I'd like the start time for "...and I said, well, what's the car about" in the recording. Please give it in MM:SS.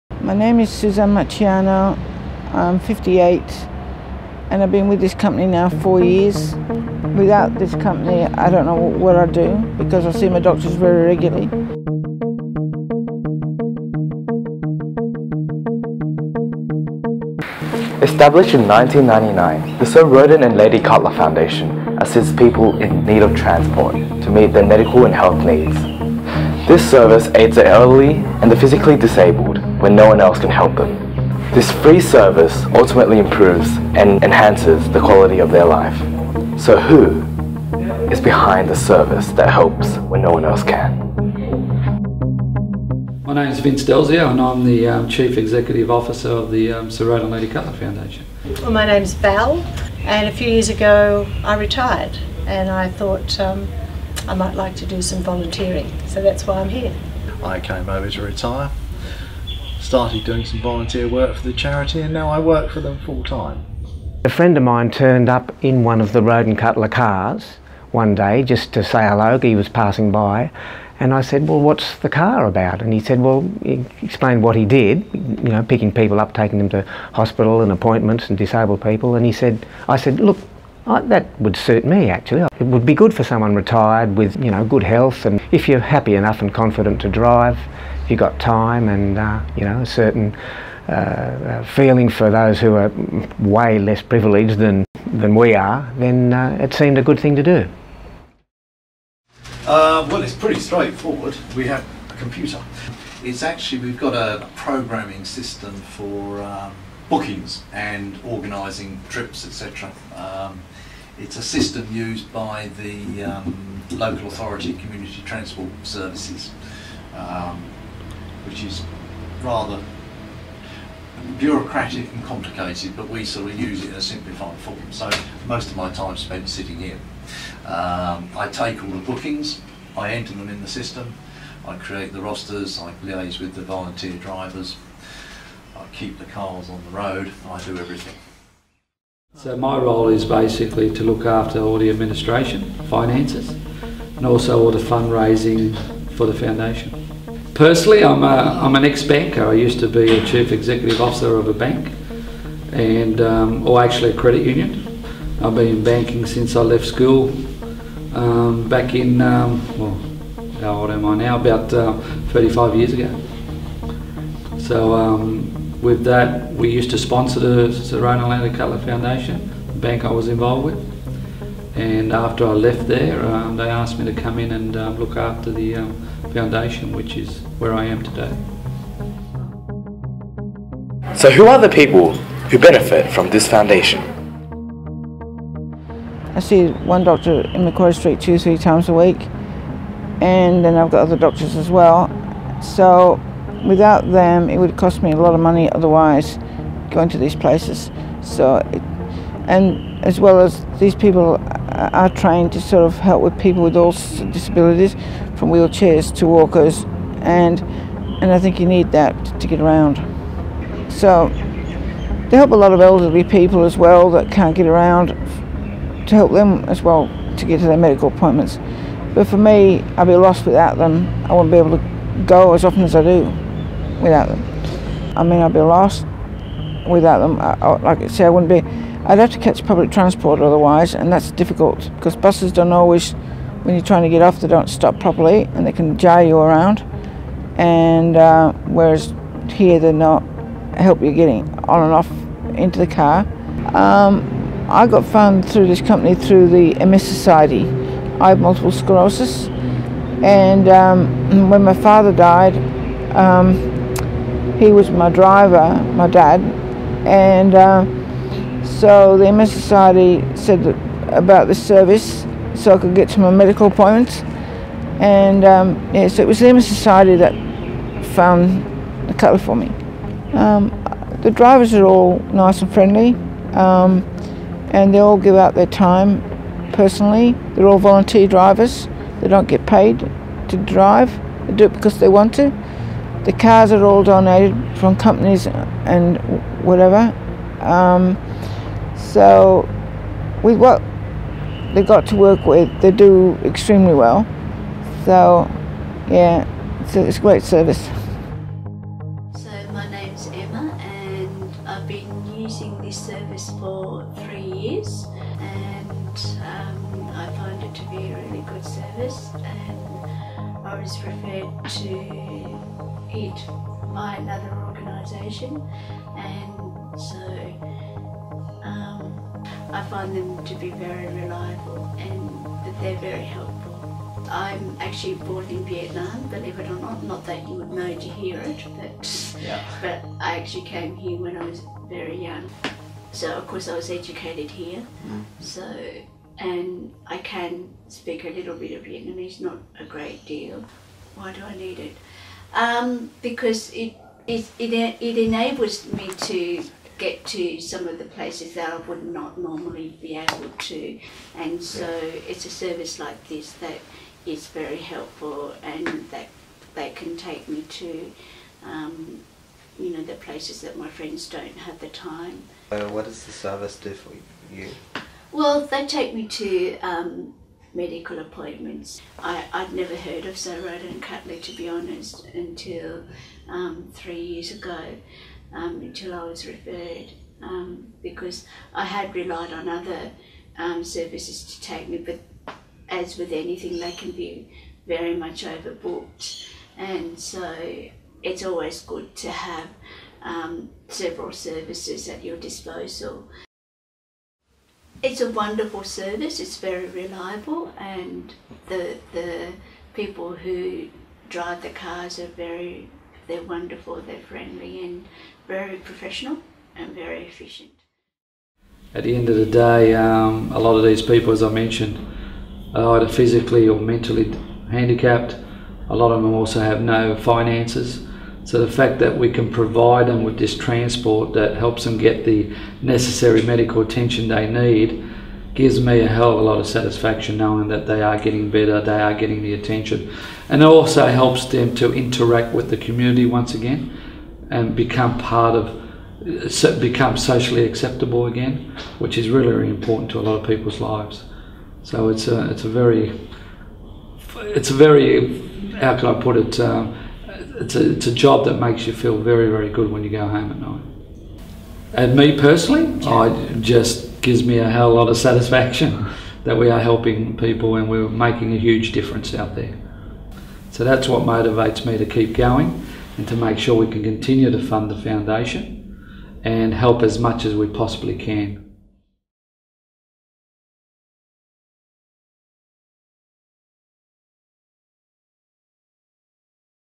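01:11.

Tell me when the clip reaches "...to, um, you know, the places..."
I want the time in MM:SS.
05:57.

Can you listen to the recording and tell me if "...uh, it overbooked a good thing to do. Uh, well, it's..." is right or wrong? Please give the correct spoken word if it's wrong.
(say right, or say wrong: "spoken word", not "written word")
wrong: "seemed", not "overbooked".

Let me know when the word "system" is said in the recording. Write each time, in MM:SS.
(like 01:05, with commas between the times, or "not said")
01:45, 01:51, 02:10.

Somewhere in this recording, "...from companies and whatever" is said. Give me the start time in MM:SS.
04:44.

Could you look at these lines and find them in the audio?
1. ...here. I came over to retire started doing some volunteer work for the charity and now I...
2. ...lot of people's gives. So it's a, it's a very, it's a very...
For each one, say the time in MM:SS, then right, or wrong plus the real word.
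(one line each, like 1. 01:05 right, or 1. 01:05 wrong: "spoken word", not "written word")
1. 00:56 right
2. 07:20 wrong: "lives", not "gives".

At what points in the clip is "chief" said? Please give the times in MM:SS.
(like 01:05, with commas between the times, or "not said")
00:45, 02:30.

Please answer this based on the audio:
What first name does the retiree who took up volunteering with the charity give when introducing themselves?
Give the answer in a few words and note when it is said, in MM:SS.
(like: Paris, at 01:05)
Val, at 00:49.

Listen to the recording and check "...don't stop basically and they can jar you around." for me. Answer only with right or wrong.
wrong.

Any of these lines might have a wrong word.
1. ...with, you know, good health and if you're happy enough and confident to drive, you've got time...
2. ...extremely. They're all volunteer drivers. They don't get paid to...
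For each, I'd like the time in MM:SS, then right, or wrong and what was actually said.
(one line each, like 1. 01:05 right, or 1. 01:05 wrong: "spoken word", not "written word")
1. 01:24 right
2. 04:36 wrong: "personally", not "extremely".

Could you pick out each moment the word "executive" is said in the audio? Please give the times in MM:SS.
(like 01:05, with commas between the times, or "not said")
00:45, 02:30.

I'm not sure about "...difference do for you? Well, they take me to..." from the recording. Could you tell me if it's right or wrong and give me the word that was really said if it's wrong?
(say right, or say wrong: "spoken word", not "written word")
wrong: "service", not "difference".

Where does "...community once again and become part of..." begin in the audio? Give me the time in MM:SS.
07:12.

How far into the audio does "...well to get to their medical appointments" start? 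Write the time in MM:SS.
03:36.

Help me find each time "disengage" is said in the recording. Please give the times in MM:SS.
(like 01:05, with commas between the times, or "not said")
not said.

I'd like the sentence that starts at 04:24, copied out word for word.
And um, yeah, so it was the MS Society that found a colour for me.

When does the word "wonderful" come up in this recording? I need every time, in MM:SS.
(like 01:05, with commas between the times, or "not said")
06:35, 06:43.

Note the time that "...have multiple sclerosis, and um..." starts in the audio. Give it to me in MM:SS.
04:08.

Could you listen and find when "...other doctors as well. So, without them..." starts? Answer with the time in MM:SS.
03:11.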